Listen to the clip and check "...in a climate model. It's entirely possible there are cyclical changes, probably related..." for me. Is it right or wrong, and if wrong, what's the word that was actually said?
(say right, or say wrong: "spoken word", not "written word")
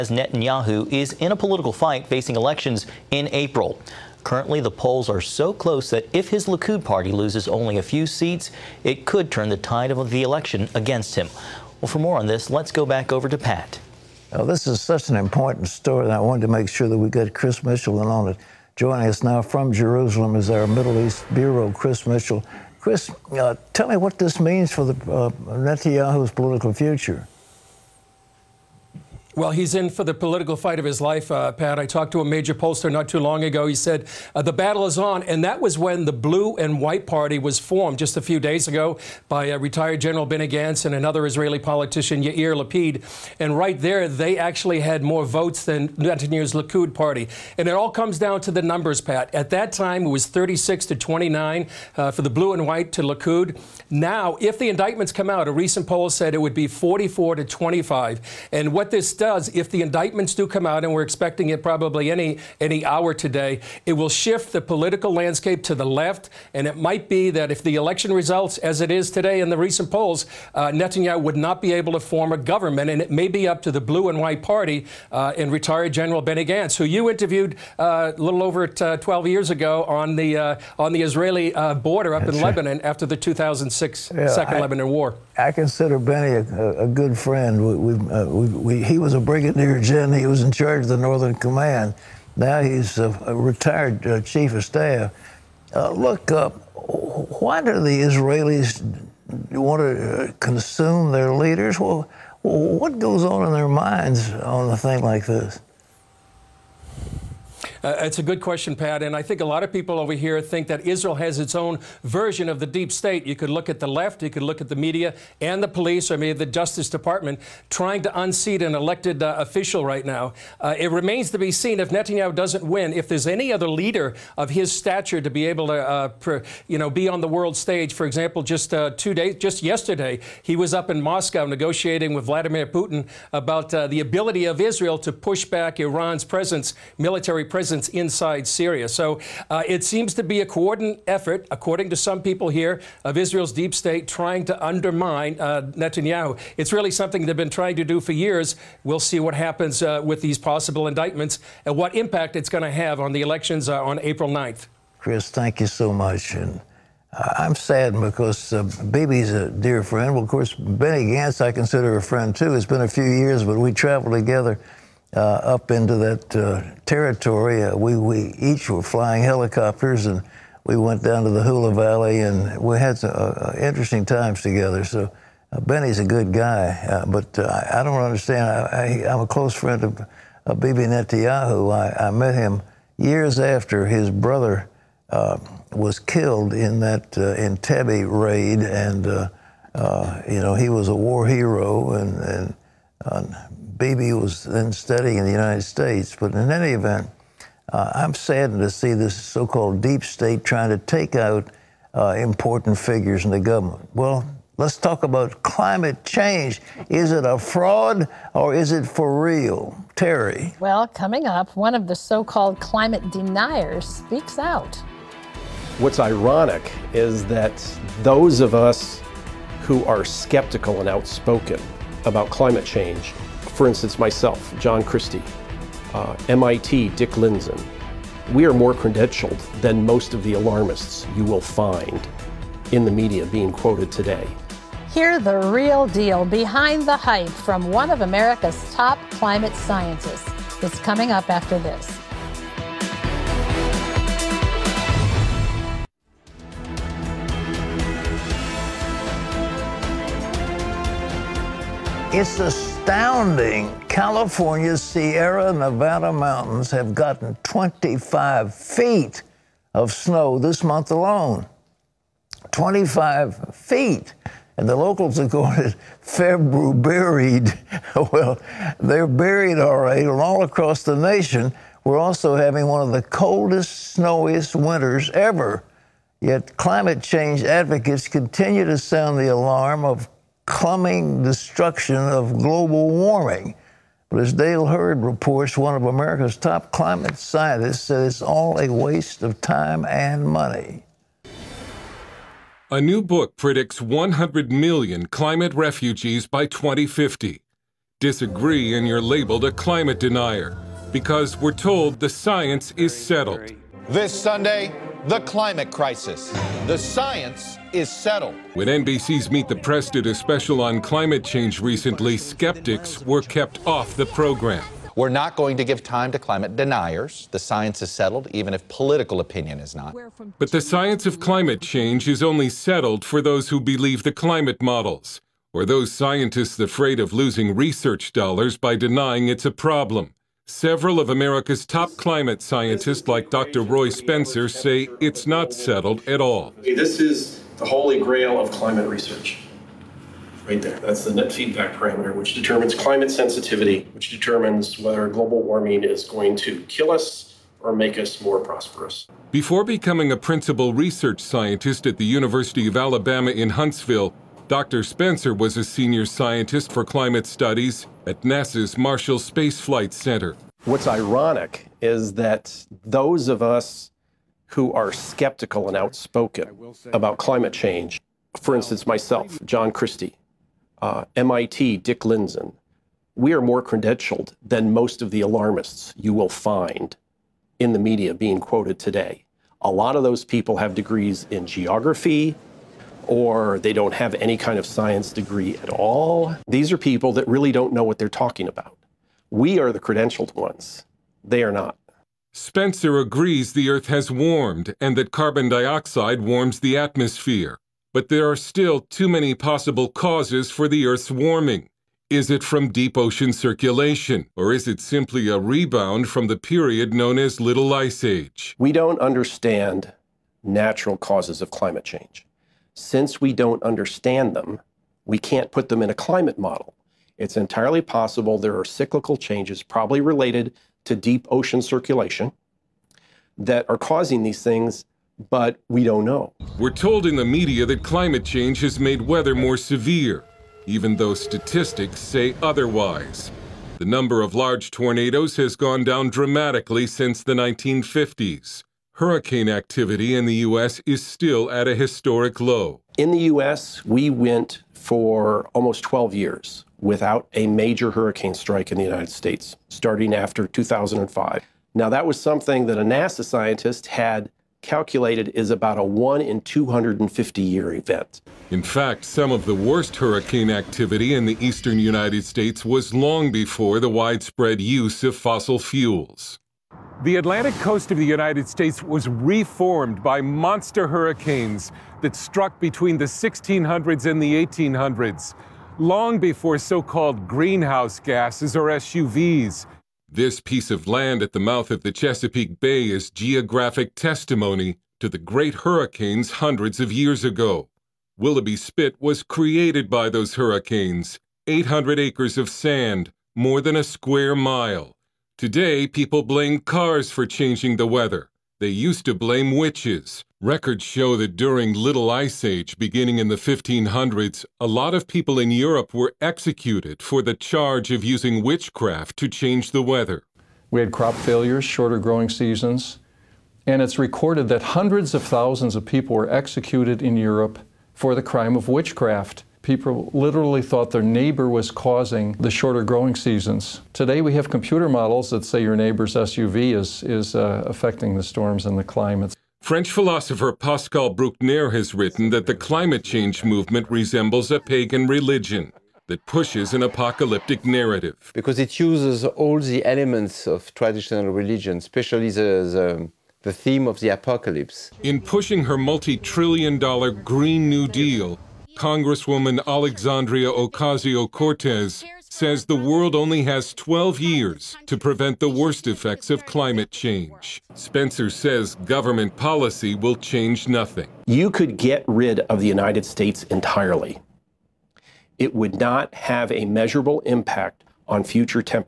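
right.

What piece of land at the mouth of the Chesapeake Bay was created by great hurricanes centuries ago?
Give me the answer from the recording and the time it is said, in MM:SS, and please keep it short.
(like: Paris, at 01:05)
Willoughby Spit, at 08:08.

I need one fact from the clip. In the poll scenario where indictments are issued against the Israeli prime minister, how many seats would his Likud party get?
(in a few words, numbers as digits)
25.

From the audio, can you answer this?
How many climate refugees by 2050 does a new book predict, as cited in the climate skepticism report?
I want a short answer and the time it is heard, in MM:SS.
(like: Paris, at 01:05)
100 million, at 04:53.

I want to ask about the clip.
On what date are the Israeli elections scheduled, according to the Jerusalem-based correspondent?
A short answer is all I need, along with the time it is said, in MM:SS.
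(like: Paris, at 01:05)
April 9th, at 02:33.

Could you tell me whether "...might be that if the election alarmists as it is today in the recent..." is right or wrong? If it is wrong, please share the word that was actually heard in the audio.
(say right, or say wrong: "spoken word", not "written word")
wrong: "results", not "alarmists".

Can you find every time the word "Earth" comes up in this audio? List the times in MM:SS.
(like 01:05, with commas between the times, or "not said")
06:33, 06:40.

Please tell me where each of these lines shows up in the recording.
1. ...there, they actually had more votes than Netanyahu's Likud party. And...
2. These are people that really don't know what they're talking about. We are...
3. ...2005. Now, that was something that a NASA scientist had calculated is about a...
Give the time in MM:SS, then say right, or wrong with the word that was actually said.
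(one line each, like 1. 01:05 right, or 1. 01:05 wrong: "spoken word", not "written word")
1. 00:43 right
2. 06:26 right
3. 07:30 right.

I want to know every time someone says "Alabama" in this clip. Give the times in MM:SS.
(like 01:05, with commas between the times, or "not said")
05:52.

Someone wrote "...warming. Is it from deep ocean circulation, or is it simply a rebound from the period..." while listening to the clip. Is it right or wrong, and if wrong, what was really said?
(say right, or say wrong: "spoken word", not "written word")
right.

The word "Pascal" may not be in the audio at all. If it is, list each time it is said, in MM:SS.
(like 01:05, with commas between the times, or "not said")
08:50.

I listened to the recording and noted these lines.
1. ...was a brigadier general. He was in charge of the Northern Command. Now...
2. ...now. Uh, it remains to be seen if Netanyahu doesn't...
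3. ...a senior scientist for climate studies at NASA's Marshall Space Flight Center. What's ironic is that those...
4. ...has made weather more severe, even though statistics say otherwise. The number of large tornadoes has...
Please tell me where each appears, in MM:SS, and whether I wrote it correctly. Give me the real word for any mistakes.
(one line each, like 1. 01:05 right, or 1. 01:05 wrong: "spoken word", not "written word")
1. 01:29 right
2. 02:00 right
3. 05:55 right
4. 07:08 right.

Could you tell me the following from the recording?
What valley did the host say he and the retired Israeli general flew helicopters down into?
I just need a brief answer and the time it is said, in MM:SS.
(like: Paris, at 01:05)
Hula Valley, at 02:51.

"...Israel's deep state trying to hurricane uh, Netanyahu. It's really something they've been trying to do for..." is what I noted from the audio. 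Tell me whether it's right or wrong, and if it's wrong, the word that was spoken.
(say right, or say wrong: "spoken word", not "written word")
wrong: "undermine", not "hurricane".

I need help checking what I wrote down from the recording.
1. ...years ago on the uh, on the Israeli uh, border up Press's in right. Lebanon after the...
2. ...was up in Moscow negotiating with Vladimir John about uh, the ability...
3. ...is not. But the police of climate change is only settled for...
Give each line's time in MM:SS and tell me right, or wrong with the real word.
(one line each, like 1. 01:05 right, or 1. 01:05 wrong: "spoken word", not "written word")
1. 01:19 wrong: "That", not "Press"
2. 02:10 wrong: "Putin", not "John"
3. 05:19 wrong: "science", not "police".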